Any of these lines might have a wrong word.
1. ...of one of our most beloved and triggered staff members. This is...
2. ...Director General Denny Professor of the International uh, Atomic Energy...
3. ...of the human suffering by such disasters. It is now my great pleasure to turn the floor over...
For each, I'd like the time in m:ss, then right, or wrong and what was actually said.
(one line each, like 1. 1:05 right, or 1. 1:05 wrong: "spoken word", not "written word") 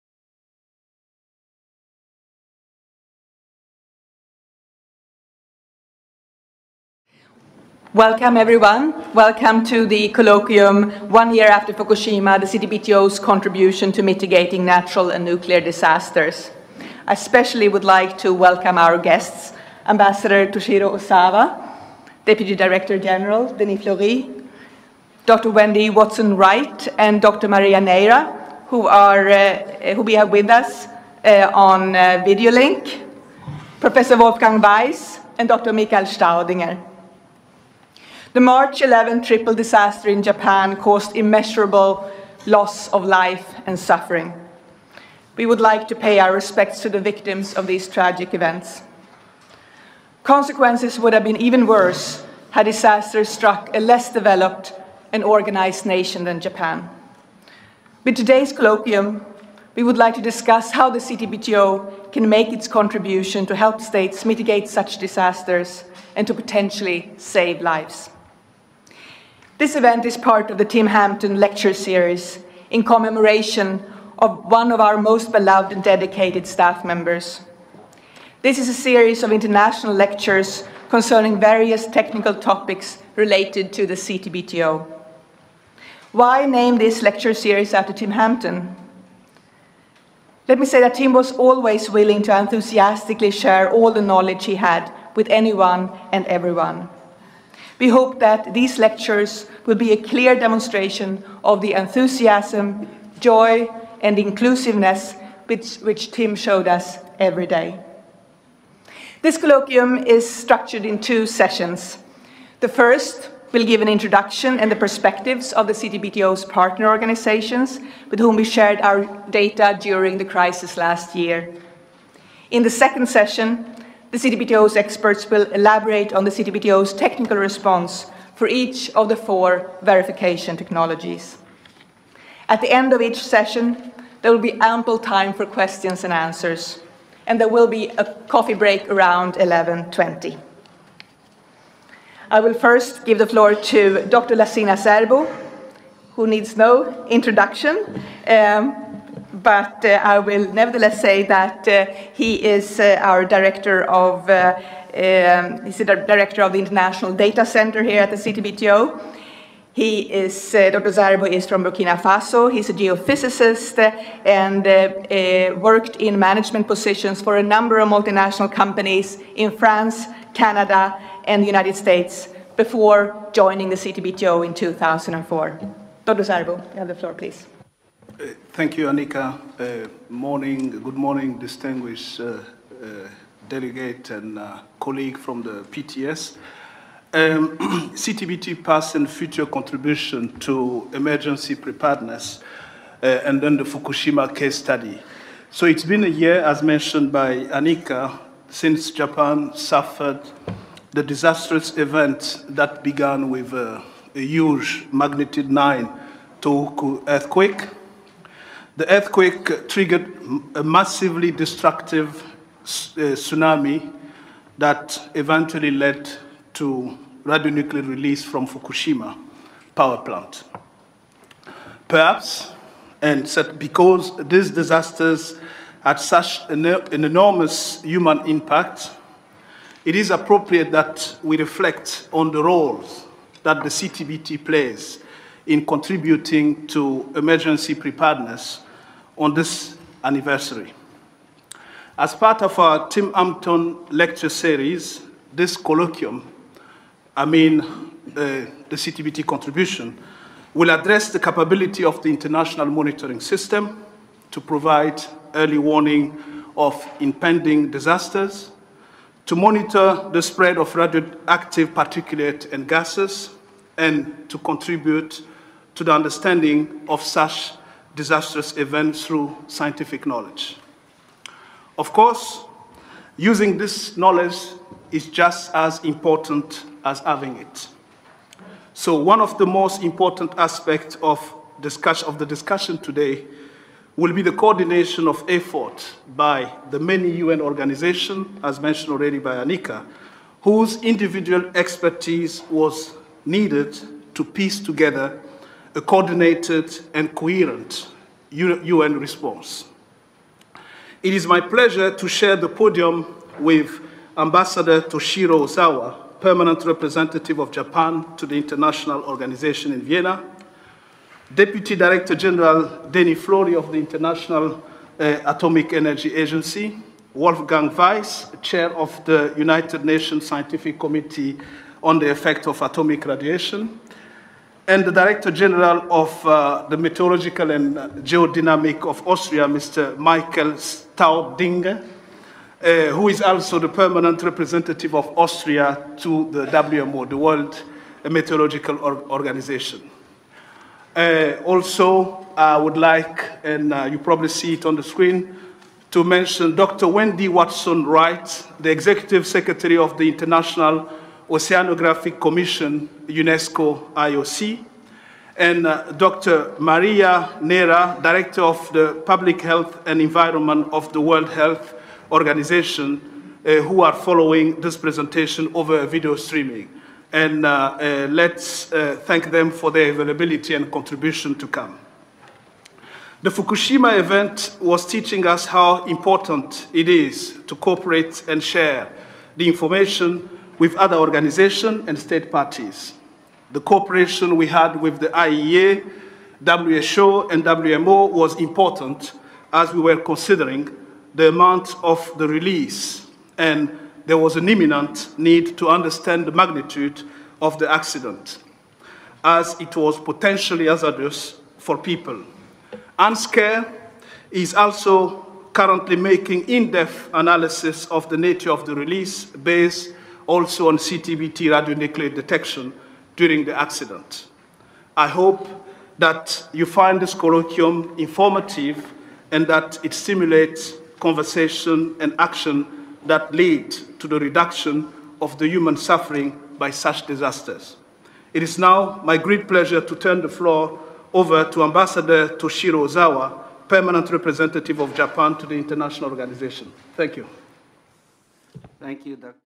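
1. 1:14 wrong: "dedicated", not "triggered"
2. 5:11 wrong: "Flory", not "Professor"
3. 7:05 right.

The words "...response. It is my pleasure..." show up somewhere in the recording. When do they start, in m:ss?
4:58.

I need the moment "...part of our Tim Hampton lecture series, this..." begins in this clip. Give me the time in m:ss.
4:02.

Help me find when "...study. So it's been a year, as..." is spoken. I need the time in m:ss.
3:14.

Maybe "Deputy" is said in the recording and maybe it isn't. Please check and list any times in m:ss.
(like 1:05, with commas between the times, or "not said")
0:22, 5:11.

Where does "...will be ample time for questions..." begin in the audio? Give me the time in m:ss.
2:14.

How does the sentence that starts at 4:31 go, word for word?
Of course, using this knowledge is just as important as having it.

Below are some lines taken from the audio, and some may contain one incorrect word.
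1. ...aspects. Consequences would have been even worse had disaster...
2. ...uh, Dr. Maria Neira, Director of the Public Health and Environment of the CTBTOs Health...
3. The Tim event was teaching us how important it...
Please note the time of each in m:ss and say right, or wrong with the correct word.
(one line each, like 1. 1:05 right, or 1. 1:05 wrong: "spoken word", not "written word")
1. 0:48 wrong: "events", not "aspects"
2. 5:55 wrong: "World", not "CTBTOs"
3. 6:13 wrong: "Fukushima", not "Tim".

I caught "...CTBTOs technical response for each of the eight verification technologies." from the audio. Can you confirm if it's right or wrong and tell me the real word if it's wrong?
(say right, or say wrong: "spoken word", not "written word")
wrong: "four", not "eight".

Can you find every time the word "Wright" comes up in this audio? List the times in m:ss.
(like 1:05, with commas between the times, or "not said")
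0:25, 5:47.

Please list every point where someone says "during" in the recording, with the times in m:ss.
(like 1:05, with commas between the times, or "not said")
1:59, 6:53.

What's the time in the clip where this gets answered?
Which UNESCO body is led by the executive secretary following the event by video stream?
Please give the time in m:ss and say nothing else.
5:50.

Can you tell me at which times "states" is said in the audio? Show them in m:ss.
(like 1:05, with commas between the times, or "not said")
1:03, 2:51, 6:21.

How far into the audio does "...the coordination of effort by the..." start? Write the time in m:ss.
4:44.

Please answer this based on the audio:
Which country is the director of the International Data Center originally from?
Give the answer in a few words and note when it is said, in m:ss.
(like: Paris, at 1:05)
Burkina Faso, at 2:41.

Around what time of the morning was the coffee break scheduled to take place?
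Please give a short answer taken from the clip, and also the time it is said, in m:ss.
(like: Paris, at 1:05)
11.20, at 2:19.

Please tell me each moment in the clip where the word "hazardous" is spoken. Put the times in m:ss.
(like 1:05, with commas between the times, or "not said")
6:40.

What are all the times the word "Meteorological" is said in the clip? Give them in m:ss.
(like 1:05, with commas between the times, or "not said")
5:26, 5:38.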